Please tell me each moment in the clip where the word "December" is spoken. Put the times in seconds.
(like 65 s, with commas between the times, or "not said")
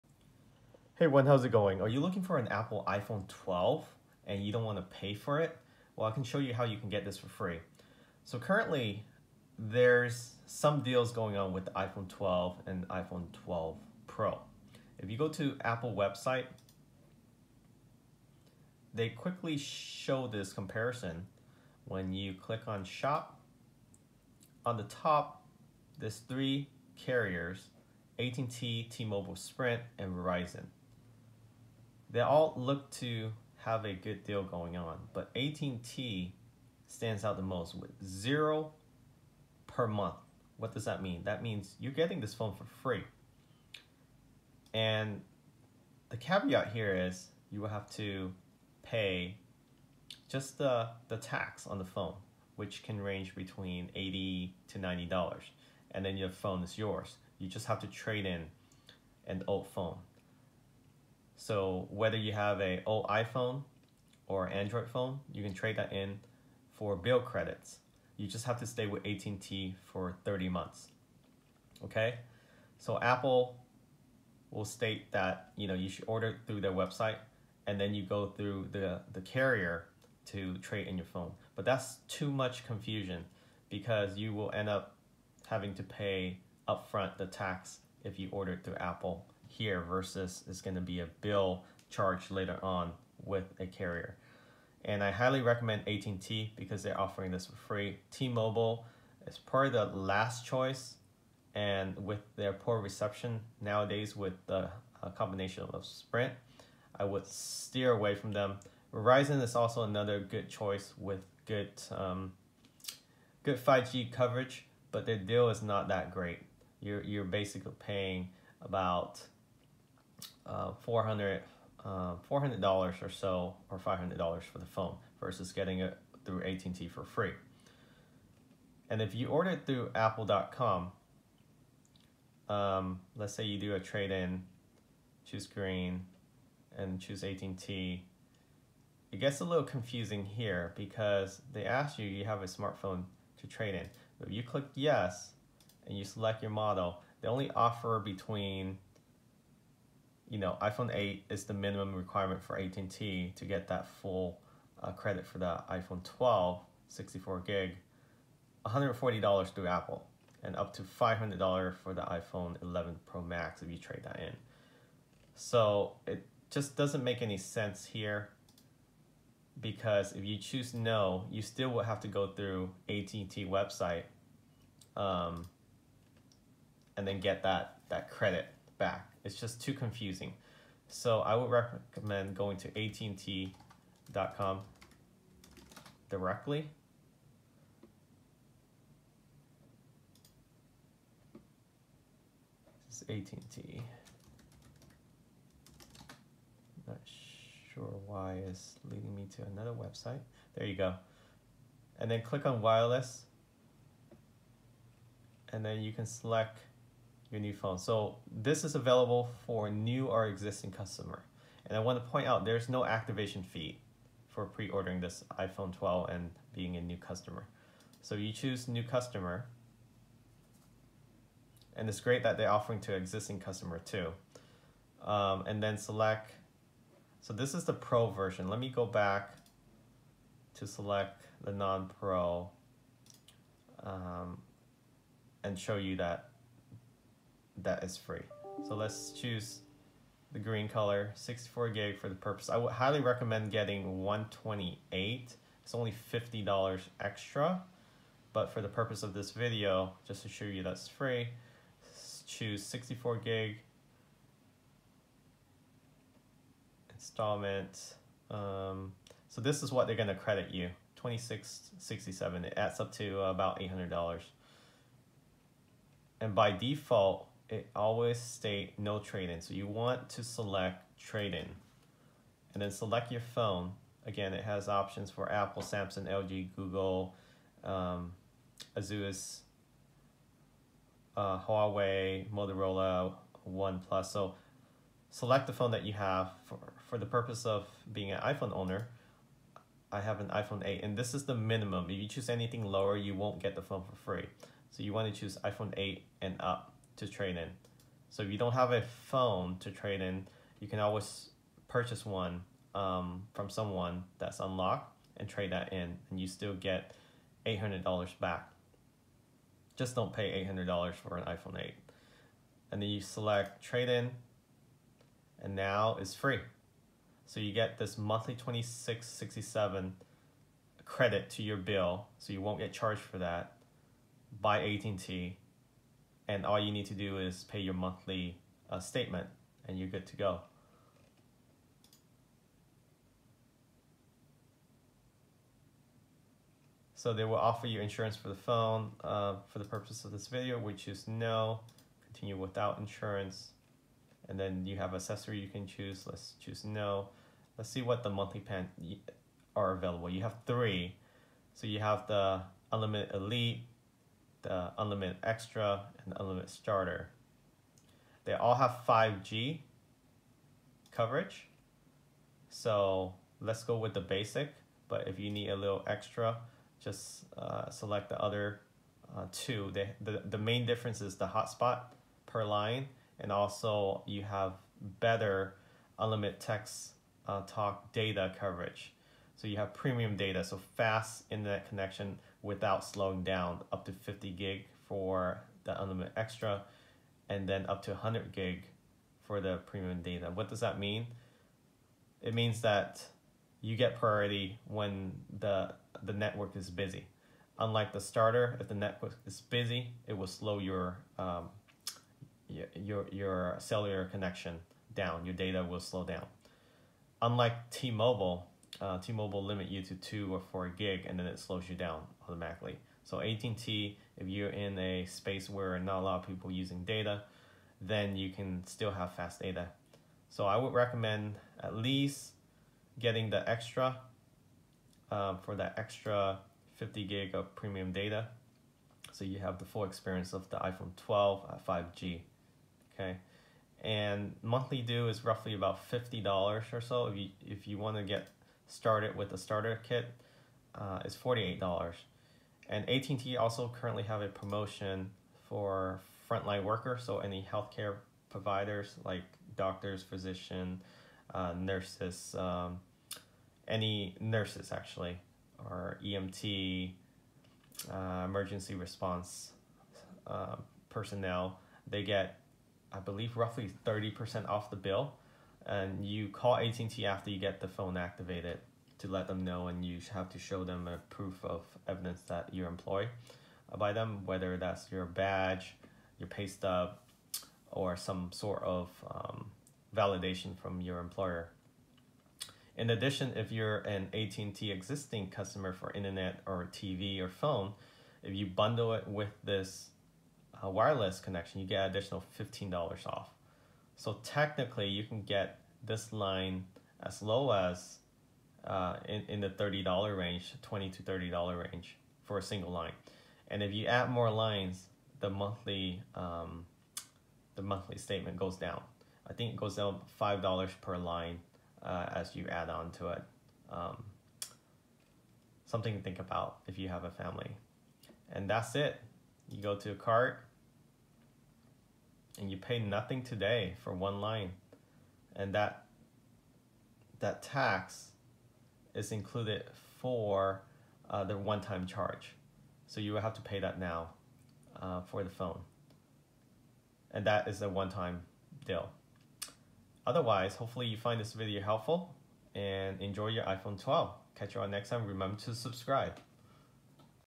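not said.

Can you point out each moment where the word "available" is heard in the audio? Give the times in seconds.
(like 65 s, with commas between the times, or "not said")
208 s, 349 s.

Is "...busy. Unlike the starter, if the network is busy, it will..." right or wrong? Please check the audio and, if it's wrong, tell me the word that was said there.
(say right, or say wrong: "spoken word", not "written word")
right.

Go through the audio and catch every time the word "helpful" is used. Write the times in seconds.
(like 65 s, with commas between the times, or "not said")
541 s.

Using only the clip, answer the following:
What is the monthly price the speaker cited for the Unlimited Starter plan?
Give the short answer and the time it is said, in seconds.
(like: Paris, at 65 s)
$48, at 441 s.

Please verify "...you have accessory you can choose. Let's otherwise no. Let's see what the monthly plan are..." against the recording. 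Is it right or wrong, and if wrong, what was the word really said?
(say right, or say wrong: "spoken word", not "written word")
wrong: "choose", not "otherwise".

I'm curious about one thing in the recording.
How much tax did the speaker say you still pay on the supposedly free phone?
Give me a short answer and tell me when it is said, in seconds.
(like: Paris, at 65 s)
80 to $90, at 53 s.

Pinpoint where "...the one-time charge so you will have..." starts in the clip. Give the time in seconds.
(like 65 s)
531 s.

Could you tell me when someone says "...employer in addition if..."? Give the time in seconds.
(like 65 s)
480 s.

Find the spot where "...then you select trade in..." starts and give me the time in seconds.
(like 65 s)
312 s.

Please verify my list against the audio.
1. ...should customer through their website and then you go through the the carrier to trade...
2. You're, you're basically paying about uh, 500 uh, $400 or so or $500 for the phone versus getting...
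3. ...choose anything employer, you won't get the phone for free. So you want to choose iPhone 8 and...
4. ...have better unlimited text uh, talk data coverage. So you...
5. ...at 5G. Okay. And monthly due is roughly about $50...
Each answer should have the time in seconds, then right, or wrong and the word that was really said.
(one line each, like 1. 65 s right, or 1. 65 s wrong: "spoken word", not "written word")
1. 75 s wrong: "order", not "customer"
2. 116 s wrong: "400", not "500"
3. 292 s wrong: "lower", not "employer"
4. 374 s right
5. 431 s right.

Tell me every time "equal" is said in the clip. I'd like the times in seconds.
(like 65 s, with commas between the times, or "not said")
not said.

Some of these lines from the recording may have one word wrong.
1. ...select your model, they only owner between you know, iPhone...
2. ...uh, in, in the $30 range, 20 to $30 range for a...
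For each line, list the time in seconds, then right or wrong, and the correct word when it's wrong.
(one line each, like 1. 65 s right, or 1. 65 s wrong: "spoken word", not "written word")
1. 146 s wrong: "offer", not "owner"
2. 498 s right.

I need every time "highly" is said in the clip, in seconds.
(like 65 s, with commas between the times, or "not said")
95 s, 242 s.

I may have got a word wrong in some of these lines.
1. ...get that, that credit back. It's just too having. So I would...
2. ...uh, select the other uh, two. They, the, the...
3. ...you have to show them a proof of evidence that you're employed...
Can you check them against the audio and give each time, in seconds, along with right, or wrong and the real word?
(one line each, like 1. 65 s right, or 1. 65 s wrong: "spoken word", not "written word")
1. 177 s wrong: "confusing", not "having"
2. 367 s right
3. 469 s right.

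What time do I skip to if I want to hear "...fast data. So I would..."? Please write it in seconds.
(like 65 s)
419 s.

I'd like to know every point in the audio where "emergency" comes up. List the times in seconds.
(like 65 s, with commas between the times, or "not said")
458 s.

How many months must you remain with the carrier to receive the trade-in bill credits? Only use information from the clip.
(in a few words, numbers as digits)
30 months.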